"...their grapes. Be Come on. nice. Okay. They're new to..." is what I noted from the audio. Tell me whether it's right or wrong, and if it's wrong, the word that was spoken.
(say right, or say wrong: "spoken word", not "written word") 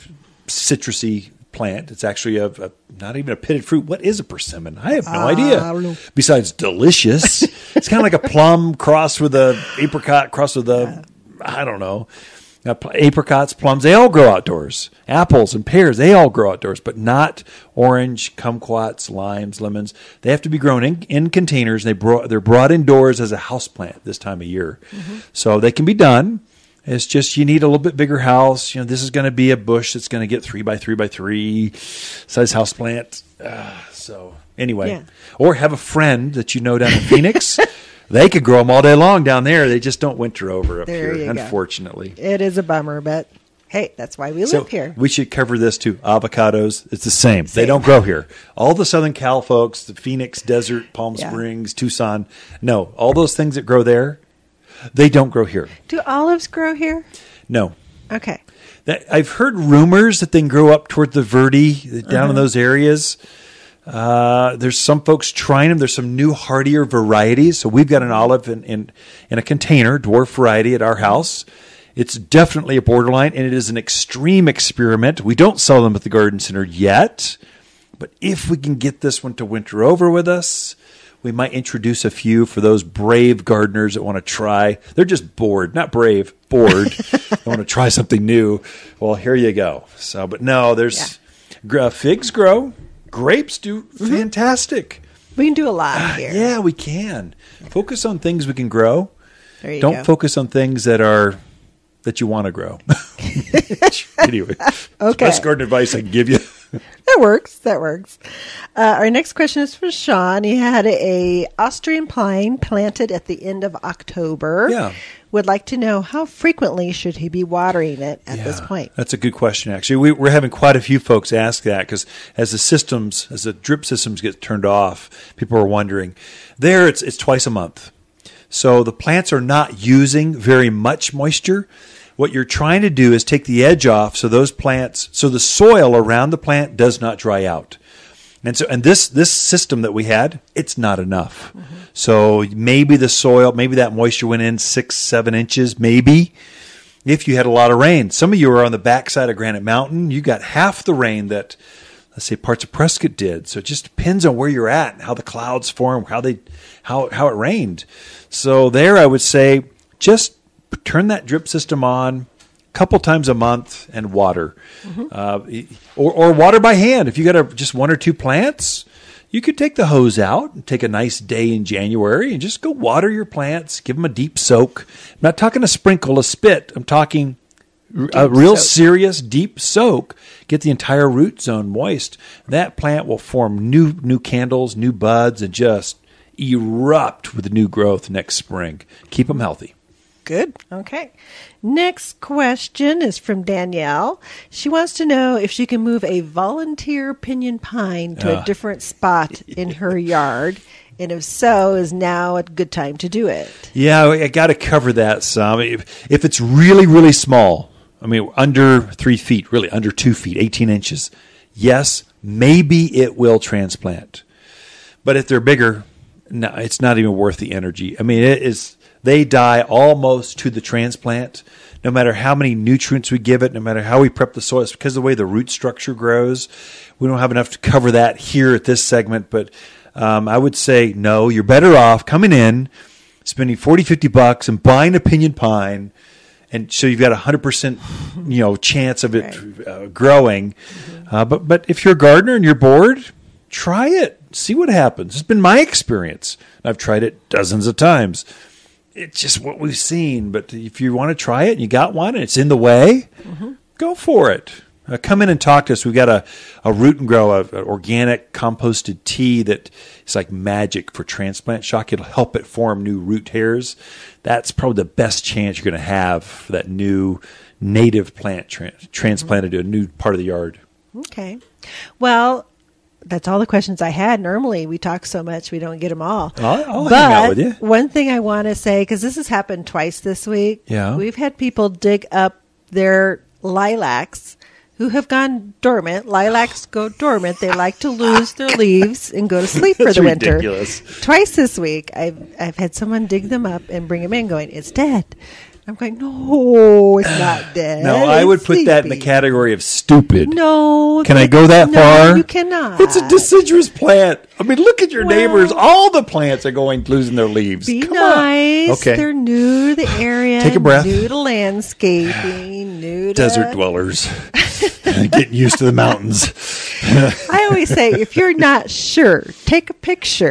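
wrong: "leaves", not "grapes".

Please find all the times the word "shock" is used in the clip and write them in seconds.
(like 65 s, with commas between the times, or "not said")
261 s.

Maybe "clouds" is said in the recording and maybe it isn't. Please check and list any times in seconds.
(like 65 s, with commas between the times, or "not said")
155 s.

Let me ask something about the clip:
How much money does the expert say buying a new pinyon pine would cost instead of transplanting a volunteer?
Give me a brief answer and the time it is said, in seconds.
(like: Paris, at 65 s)
$40-50, at 233 s.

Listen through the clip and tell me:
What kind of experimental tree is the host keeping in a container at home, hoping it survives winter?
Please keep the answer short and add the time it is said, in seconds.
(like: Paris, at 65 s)
Olive, at 68 s.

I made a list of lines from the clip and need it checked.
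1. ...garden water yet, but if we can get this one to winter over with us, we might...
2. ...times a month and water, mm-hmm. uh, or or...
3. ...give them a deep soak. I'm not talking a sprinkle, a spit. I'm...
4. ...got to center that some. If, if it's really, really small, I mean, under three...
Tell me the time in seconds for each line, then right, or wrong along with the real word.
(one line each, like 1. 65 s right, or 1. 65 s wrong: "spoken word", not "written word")
1. 76 s wrong: "center", not "water"
2. 162 s right
3. 173 s right
4. 204 s wrong: "cover", not "center".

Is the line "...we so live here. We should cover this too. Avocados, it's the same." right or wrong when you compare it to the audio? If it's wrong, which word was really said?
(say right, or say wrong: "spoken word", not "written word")
right.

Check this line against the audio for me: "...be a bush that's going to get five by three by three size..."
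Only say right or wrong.
wrong.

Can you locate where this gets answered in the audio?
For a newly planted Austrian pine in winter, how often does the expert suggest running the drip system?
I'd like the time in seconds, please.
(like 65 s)
127 s.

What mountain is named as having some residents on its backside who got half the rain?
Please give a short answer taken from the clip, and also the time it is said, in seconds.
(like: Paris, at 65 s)
Granite Mountain, at 149 s.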